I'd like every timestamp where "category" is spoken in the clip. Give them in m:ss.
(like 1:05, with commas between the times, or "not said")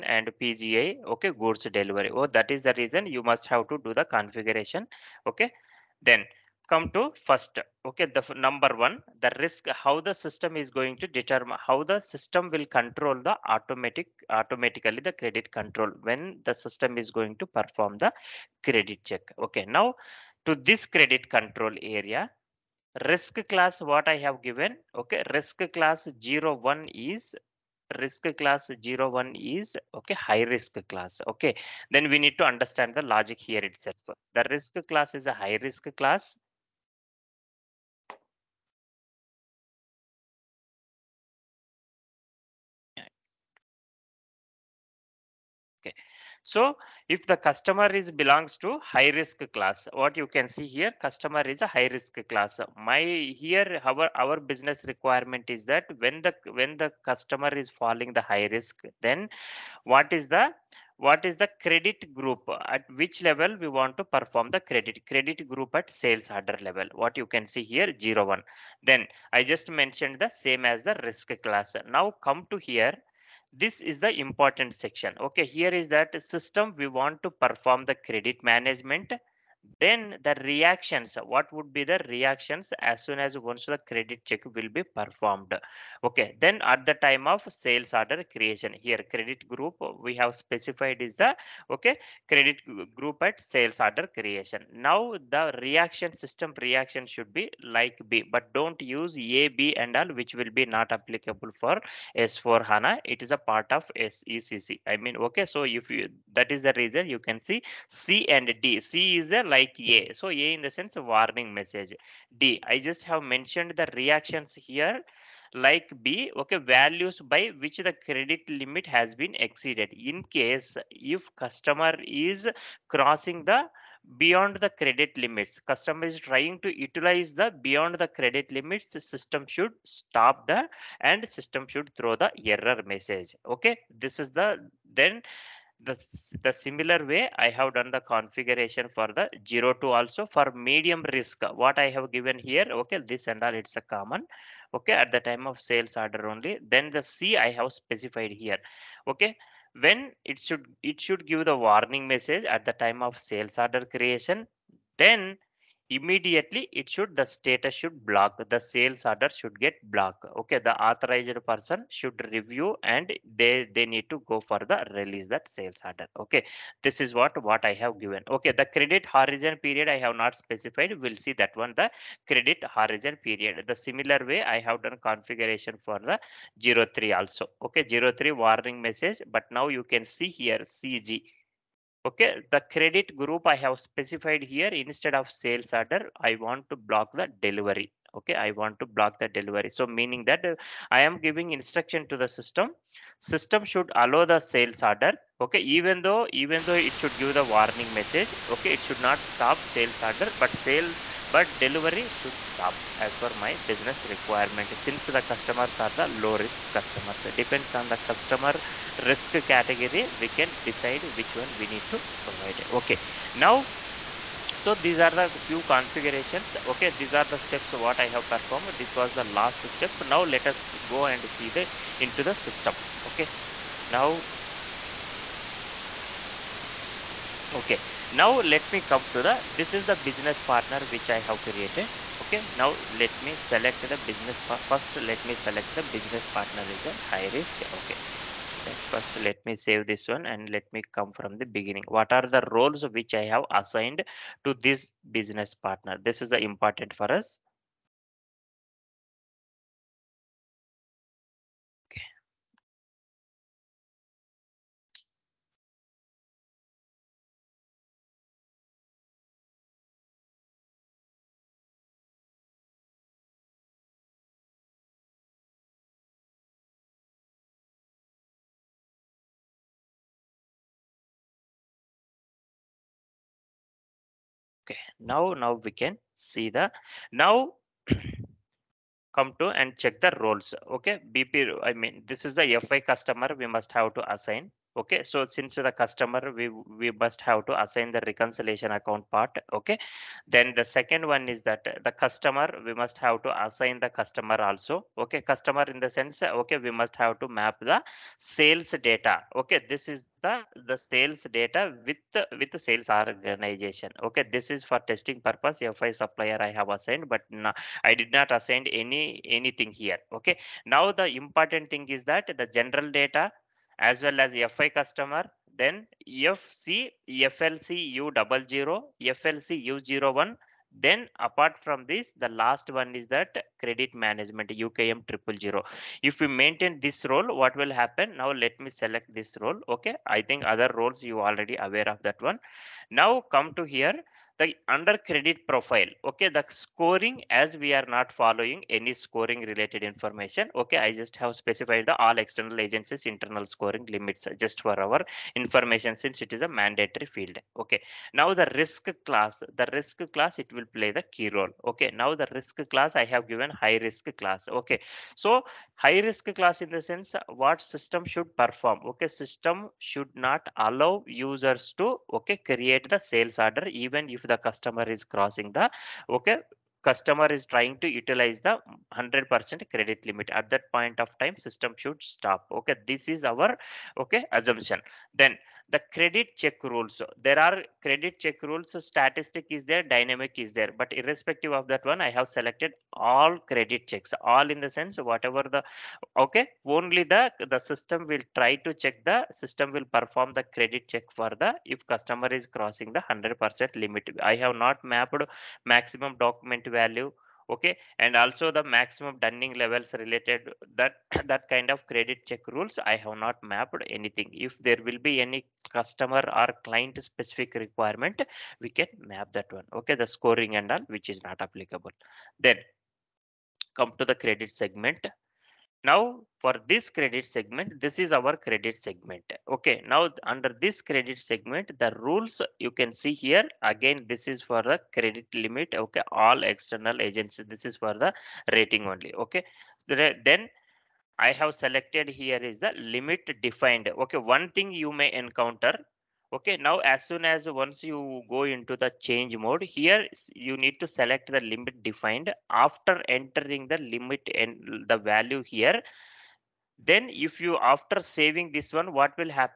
3:29.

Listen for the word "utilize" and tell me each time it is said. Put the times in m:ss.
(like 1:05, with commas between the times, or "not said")
2:06, 6:07.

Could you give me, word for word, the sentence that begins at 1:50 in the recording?
So A in the sense of warning message.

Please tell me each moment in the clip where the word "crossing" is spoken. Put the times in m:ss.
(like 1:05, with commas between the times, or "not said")
2:02, 6:05, 6:32.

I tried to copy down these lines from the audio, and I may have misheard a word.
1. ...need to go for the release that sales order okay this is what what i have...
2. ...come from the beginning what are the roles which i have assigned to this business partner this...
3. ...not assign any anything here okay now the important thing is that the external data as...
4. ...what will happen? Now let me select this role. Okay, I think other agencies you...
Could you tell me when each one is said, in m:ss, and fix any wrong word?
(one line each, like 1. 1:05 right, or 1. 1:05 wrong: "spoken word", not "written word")
1. 2:43 right
2. 4:00 right
3. 5:08 wrong: "general", not "external"
4. 5:27 wrong: "roles", not "agencies".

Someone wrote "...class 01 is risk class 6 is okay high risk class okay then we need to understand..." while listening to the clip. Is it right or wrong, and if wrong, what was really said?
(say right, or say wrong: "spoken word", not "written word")
wrong: "1", not "6".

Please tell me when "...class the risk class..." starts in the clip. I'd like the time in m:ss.
5:49.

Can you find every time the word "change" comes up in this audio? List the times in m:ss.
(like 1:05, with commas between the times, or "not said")
7:18.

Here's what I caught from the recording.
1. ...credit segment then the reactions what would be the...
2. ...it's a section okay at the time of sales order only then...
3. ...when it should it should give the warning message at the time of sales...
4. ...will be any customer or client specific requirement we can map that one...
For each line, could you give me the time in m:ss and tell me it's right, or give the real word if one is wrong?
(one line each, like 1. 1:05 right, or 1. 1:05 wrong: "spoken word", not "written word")
1. 1:17 wrong: "management", not "segment"
2. 2:23 wrong: "common", not "section"
3. 2:29 right
4. 6:44 right.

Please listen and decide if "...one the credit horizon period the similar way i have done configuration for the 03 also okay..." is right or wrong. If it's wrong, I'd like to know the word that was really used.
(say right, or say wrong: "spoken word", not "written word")
right.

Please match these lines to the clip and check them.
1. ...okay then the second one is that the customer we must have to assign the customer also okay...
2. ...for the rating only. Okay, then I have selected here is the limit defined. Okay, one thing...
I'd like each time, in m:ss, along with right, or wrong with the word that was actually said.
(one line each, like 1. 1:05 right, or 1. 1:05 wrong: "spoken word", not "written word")
1. 4:49 right
2. 7:07 right.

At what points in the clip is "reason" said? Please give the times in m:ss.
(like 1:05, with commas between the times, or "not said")
0:02, 1:46.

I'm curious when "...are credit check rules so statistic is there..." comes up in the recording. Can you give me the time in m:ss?
6:17.